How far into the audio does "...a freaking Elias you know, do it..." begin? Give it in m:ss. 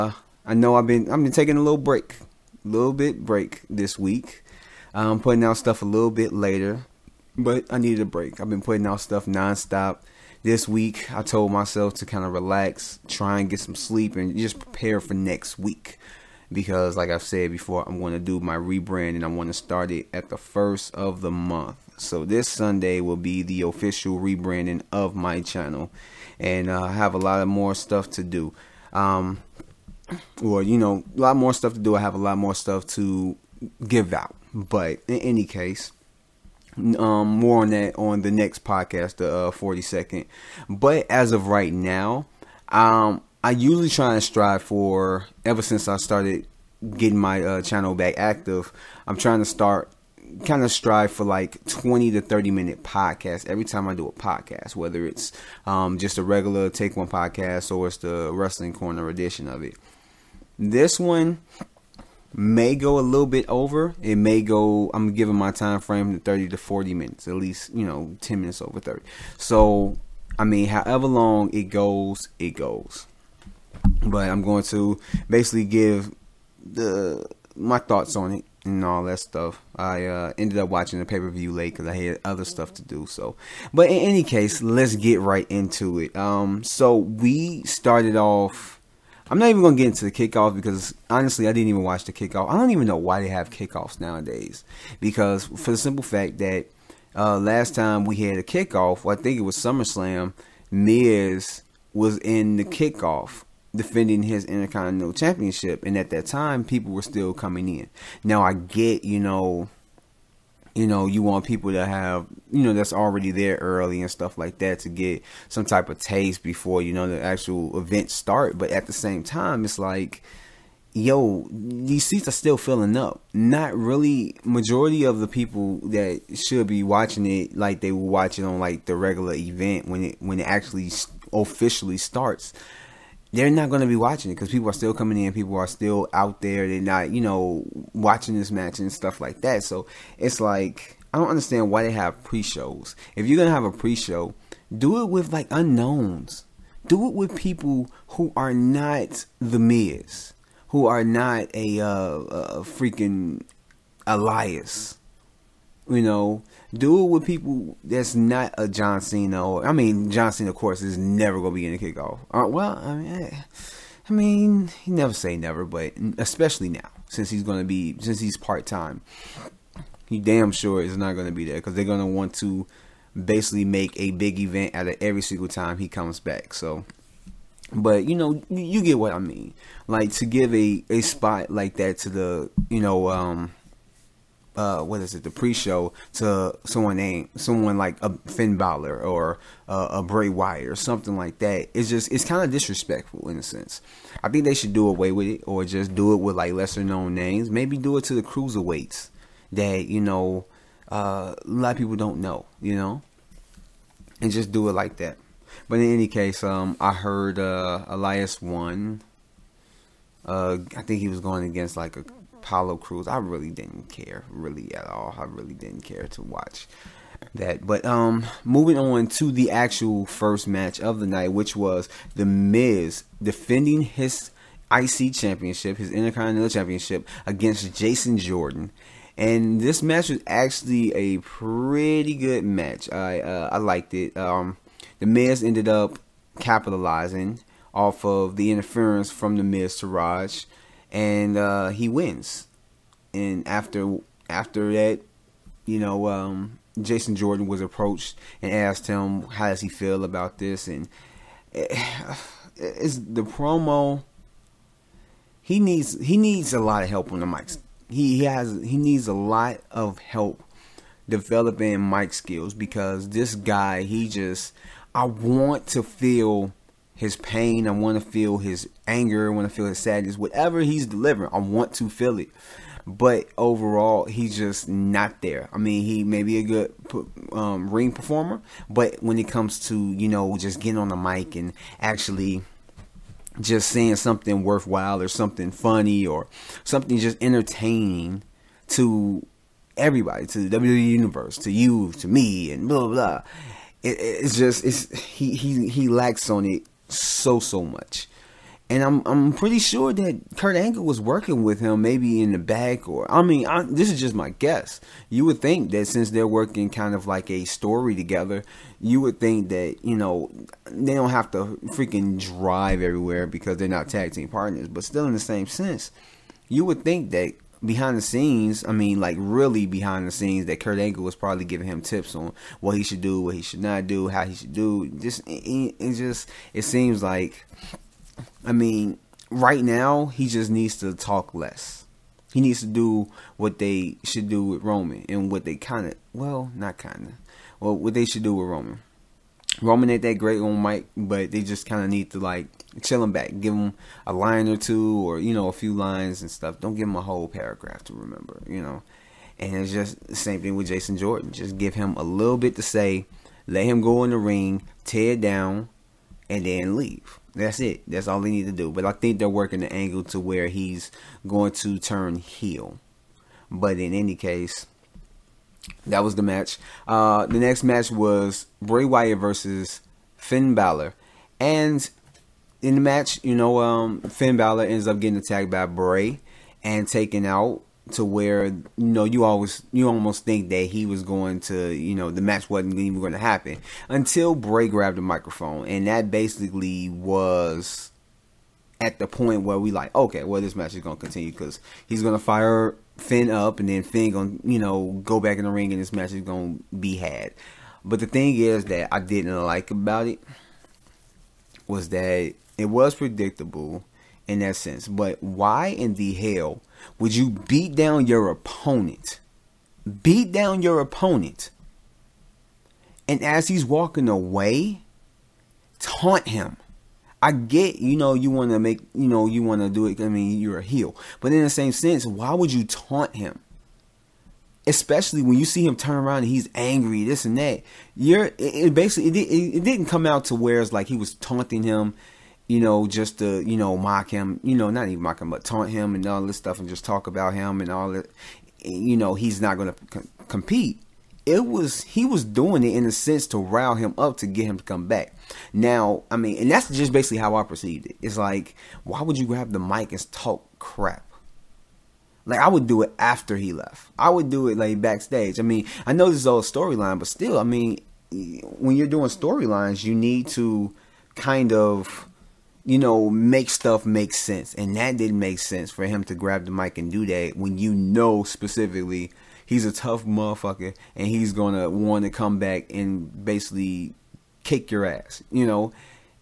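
2:32.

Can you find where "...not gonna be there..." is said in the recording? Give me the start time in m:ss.
2:50.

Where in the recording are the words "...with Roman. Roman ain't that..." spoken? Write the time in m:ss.
5:38.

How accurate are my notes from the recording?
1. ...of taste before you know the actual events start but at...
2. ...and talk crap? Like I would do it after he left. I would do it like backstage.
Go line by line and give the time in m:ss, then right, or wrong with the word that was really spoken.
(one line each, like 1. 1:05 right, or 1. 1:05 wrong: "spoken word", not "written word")
1. 1:55 right
2. 7:29 right.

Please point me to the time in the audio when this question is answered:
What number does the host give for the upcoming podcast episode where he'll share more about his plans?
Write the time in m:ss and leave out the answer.
0:39.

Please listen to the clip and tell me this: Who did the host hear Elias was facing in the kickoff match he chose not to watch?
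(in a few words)
Apollo Crews.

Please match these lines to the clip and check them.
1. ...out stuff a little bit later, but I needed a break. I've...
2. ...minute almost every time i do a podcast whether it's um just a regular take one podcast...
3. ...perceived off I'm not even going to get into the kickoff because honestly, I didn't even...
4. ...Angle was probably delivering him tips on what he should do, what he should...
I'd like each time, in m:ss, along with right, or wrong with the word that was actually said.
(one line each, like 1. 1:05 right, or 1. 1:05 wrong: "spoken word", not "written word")
1. 0:05 right
2. 0:52 wrong: "podcast", not "almost"
3. 1:27 wrong: "started", not "perceived"
4. 5:20 wrong: "giving", not "delivering".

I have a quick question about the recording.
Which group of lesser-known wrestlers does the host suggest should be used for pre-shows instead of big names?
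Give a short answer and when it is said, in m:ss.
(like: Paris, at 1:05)
cruiserweights, at 3:18.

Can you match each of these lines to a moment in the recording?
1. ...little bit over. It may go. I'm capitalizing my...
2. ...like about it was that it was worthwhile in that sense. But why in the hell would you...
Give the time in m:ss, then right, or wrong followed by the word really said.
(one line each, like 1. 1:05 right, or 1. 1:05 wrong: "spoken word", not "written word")
1. 1:03 wrong: "giving", not "capitalizing"
2. 6:39 wrong: "predictable", not "worthwhile".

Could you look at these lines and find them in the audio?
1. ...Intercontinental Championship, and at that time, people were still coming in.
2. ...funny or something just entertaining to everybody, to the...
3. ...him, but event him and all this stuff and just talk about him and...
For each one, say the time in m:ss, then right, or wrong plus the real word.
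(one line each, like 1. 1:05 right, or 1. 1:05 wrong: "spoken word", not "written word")
1. 1:44 right
2. 4:45 right
3. 7:15 wrong: "taunt", not "event".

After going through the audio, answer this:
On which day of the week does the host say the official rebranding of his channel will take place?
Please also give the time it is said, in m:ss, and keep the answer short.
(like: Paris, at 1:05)
Sunday, at 0:22.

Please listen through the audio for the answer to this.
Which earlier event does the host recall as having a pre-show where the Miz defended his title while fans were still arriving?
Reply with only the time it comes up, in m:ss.
1:39.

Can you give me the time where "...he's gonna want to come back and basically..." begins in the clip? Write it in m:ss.
7:51.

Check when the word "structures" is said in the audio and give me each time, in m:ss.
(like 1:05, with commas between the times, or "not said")
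not said.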